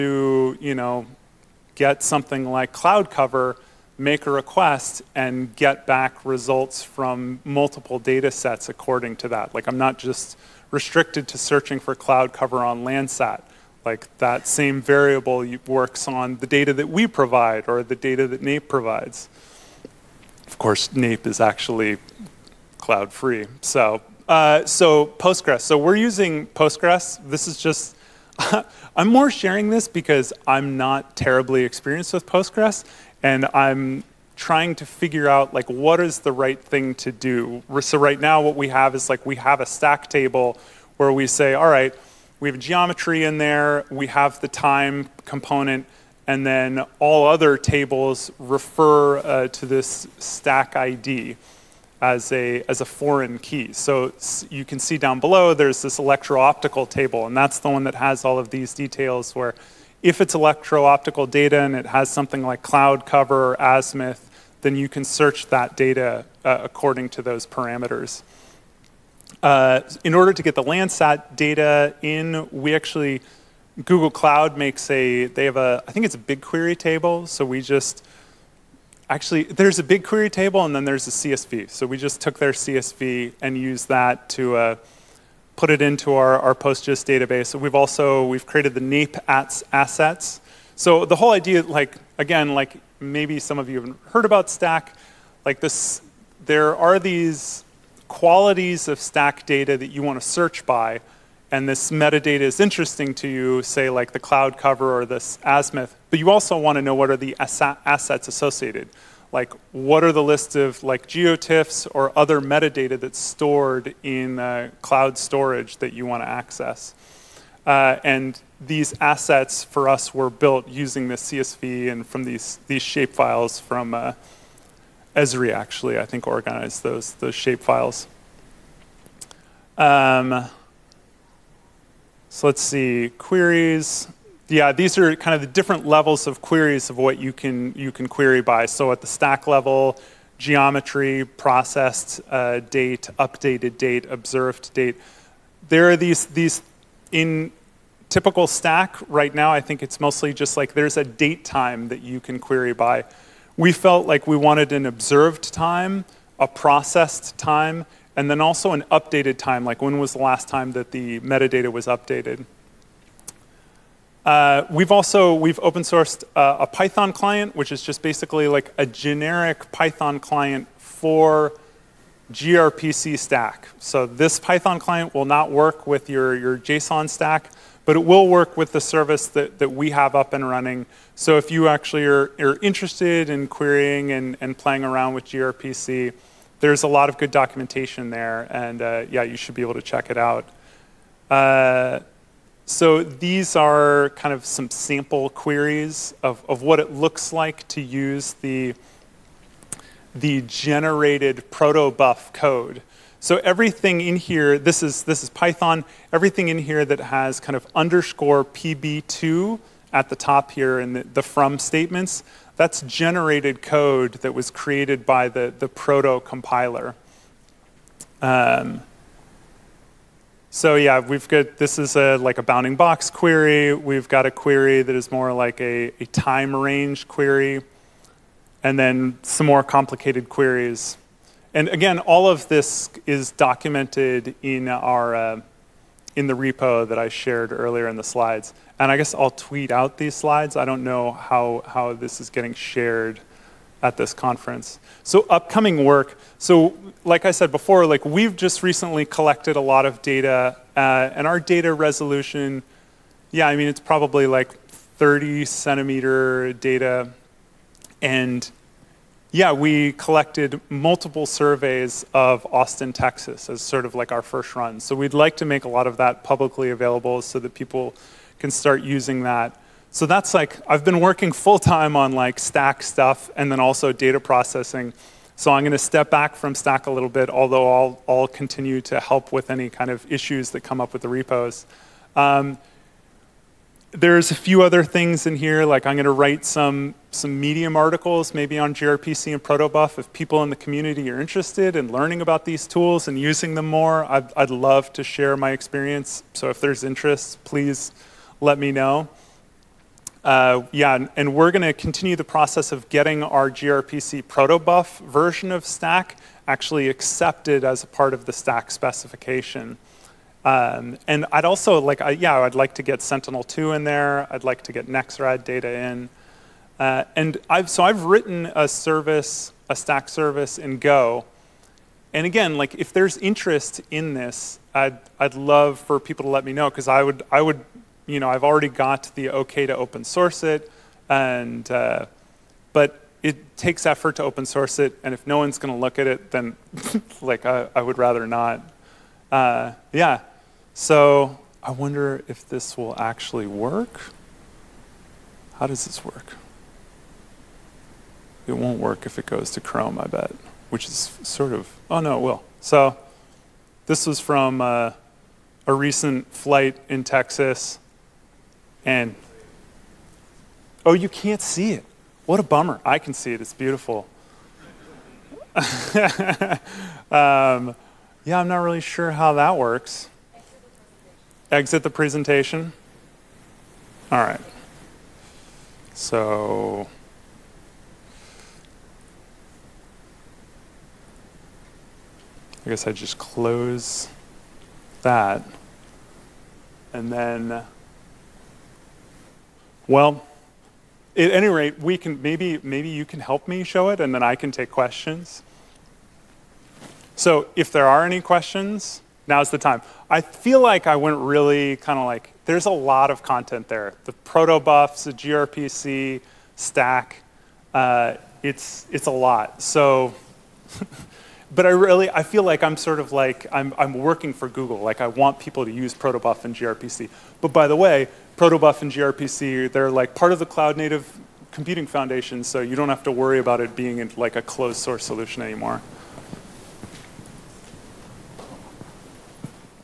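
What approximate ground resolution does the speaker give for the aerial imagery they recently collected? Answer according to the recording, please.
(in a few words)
30 centimeters.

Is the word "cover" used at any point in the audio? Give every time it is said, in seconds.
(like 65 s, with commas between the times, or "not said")
3 s, 12 s, 63 s, 104 s.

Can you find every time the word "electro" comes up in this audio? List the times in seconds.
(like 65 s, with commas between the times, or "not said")
55 s, 60 s.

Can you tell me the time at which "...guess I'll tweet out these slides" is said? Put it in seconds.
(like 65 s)
238 s.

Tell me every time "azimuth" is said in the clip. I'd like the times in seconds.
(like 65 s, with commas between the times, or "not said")
63 s, 105 s.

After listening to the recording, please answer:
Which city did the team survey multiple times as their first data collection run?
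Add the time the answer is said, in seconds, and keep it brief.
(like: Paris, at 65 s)
Austin, Texas, at 262 s.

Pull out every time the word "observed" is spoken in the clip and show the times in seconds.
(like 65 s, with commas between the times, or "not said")
144 s, 154 s.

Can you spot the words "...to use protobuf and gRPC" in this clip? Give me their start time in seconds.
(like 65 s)
415 s.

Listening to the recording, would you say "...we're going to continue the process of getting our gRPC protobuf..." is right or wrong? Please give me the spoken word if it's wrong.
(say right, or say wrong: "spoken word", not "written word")
right.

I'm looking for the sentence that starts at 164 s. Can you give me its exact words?
Uh, we've also, we've open sourced uh, a Python client, which is just basically like a generic Python client for gRPC STAC.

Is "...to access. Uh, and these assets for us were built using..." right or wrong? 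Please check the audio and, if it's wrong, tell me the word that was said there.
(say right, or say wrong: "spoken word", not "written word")
right.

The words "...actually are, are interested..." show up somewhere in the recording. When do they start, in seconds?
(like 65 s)
181 s.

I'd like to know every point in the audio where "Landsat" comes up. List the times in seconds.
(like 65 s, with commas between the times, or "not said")
12 s, 70 s.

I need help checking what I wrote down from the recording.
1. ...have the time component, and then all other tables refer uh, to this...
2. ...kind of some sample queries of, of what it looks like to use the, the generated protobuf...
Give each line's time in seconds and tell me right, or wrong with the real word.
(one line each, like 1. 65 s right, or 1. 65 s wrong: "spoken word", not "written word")
1. 44 s right
2. 194 s right.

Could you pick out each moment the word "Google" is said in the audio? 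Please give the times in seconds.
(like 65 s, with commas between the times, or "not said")
73 s, 414 s.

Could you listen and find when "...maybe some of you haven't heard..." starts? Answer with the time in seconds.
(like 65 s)
92 s.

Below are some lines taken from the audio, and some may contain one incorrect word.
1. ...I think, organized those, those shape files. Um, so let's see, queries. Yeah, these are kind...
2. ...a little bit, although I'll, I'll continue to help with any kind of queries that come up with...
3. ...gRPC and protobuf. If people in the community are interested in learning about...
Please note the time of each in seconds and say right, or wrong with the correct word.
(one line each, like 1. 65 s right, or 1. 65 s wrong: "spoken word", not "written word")
1. 125 s right
2. 276 s wrong: "issues", not "queries"
3. 288 s right.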